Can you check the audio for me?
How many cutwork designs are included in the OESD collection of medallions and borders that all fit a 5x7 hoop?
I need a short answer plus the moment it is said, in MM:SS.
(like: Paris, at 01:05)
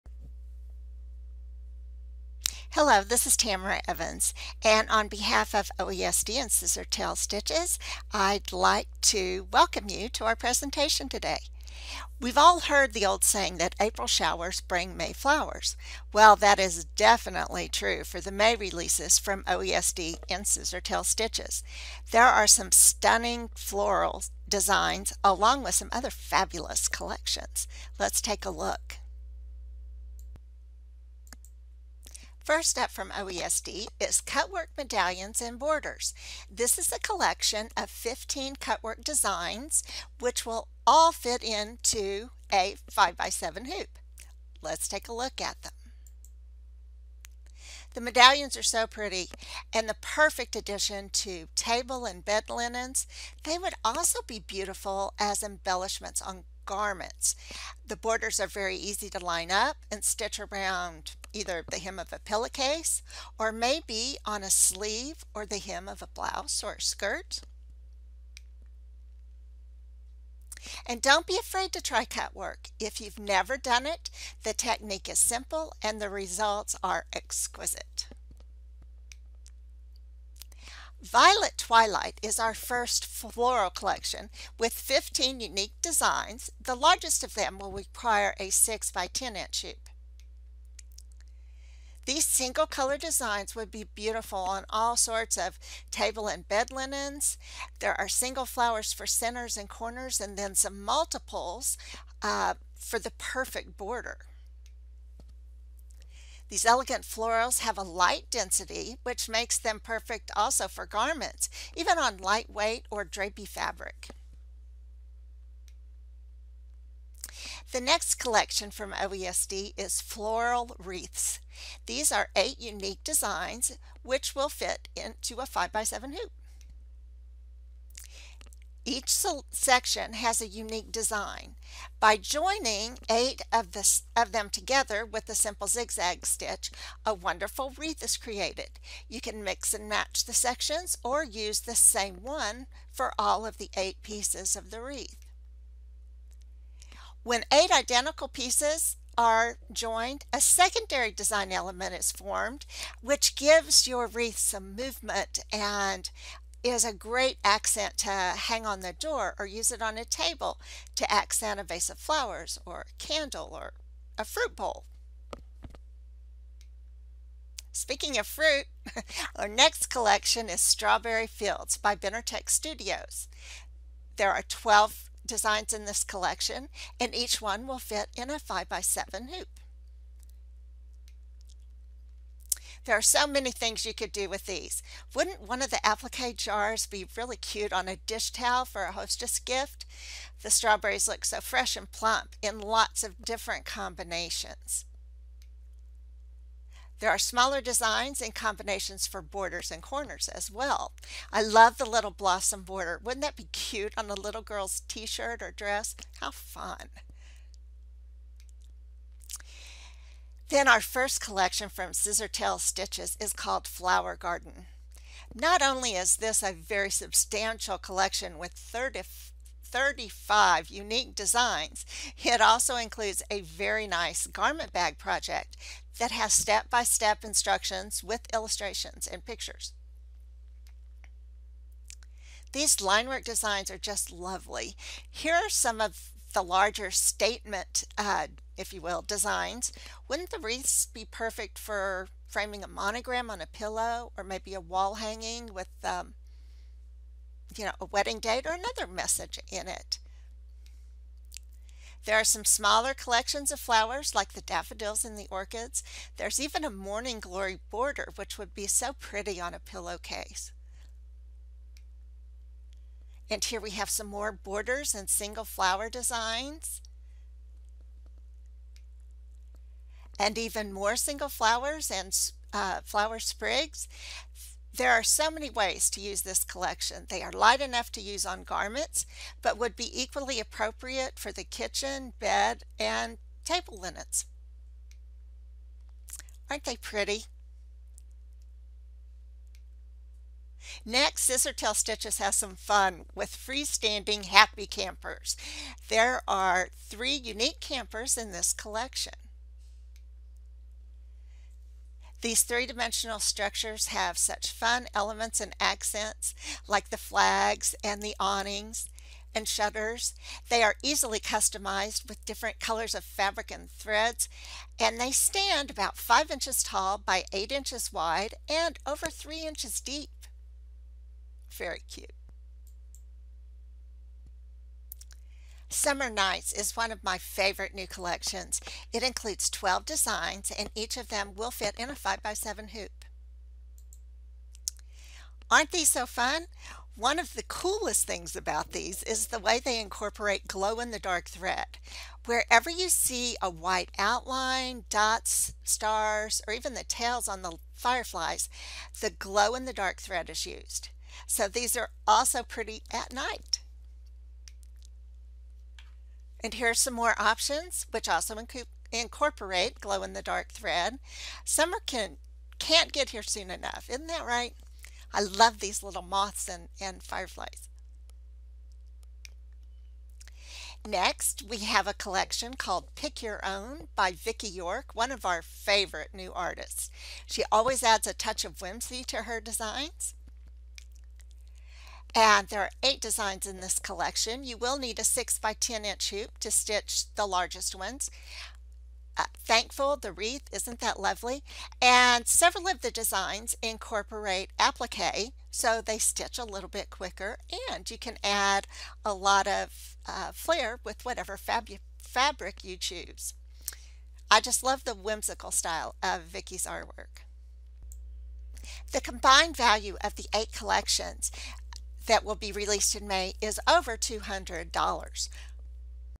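15, at 00:37.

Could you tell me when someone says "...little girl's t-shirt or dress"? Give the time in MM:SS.
03:24.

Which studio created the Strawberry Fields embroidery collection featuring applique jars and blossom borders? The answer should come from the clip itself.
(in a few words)
Benertech Studios.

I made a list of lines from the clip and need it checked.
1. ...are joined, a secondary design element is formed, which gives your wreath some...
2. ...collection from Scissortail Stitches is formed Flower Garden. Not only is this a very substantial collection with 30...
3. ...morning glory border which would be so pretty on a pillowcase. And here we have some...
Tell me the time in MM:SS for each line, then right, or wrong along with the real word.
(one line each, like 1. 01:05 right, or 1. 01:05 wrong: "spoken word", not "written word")
1. 02:29 right
2. 03:31 wrong: "called", not "formed"
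3. 04:16 right.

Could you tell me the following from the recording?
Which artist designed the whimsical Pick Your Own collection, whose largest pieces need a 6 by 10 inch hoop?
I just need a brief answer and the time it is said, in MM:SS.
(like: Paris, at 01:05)
Vicki York, at 06:14.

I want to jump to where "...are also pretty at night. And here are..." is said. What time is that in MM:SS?
05:51.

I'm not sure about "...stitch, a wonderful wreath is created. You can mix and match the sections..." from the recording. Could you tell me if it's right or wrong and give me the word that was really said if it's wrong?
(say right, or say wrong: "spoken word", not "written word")
right.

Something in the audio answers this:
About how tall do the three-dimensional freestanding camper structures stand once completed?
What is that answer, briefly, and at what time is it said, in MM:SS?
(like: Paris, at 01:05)
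5 inches, at 05:15.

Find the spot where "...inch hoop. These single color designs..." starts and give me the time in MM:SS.
01:29.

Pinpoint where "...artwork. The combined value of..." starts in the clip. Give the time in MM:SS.
06:46.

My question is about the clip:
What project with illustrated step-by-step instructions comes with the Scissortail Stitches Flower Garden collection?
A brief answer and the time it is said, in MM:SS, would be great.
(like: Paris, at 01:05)
Garment bag, at 03:44.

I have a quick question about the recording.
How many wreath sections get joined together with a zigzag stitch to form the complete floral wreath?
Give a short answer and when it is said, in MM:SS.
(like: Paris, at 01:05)
8, at 02:13.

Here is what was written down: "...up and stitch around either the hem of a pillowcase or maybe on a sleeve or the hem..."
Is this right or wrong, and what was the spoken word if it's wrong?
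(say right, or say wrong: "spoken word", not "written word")
right.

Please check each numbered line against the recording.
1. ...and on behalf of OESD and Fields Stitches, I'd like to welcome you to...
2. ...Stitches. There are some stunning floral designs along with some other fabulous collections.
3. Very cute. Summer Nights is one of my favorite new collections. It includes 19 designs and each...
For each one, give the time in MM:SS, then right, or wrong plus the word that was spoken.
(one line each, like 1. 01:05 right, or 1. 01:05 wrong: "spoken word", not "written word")
1. 00:04 wrong: "Scissortail", not "Fields"
2. 00:21 right
3. 05:21 wrong: "12", not "19".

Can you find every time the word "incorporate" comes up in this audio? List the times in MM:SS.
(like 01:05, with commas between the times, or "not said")
05:39, 05:58, 06:33.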